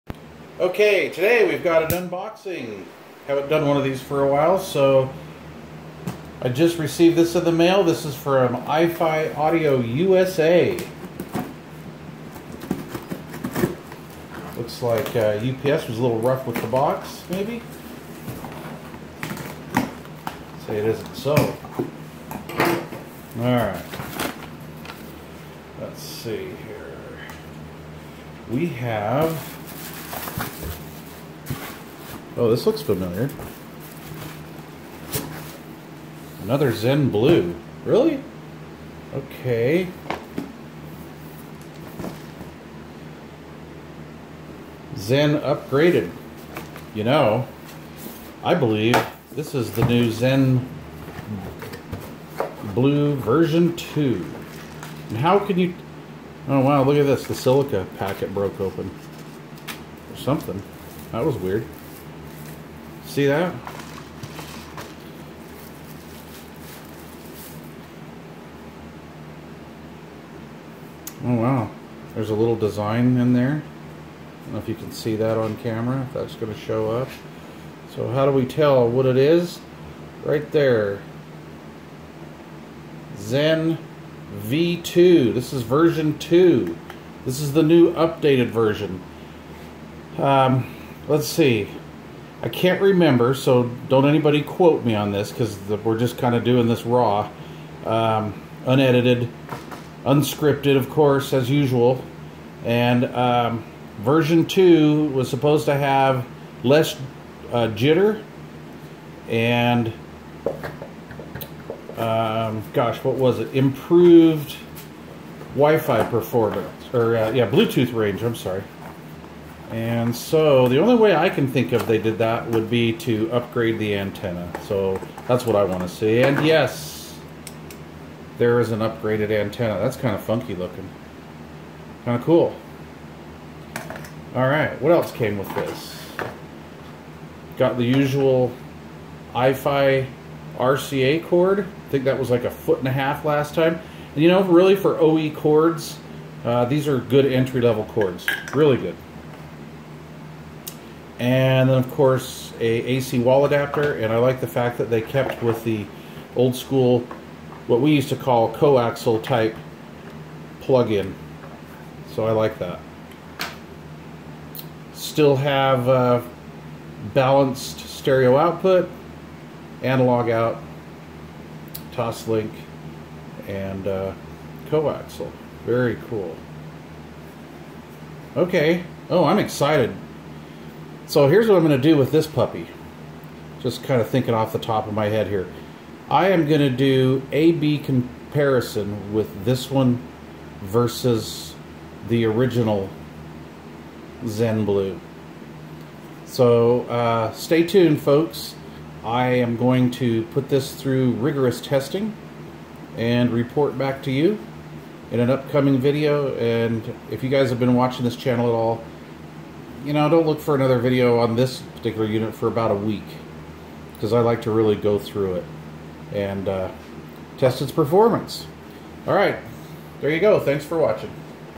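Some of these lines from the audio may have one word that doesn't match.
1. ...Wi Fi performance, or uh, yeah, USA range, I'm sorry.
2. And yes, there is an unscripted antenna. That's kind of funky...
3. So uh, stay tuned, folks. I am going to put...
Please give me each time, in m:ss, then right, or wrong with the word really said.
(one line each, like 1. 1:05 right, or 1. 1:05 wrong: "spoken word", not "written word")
1. 1:55 wrong: "Bluetooth", not "USA"
2. 2:06 wrong: "upgraded", not "unscripted"
3. 3:16 right.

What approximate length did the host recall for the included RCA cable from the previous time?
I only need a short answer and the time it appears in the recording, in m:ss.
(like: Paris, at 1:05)
a foot and a half, at 2:22.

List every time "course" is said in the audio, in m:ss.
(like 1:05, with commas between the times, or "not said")
1:40, 2:31.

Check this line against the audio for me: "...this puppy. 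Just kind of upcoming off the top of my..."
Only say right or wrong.
wrong.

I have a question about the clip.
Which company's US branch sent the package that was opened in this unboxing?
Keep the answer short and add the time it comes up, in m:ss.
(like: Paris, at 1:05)
iFi Audio USA, at 0:08.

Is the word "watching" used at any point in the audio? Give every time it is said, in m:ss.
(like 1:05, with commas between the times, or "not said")
3:27, 3:40.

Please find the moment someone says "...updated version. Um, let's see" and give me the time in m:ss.
1:27.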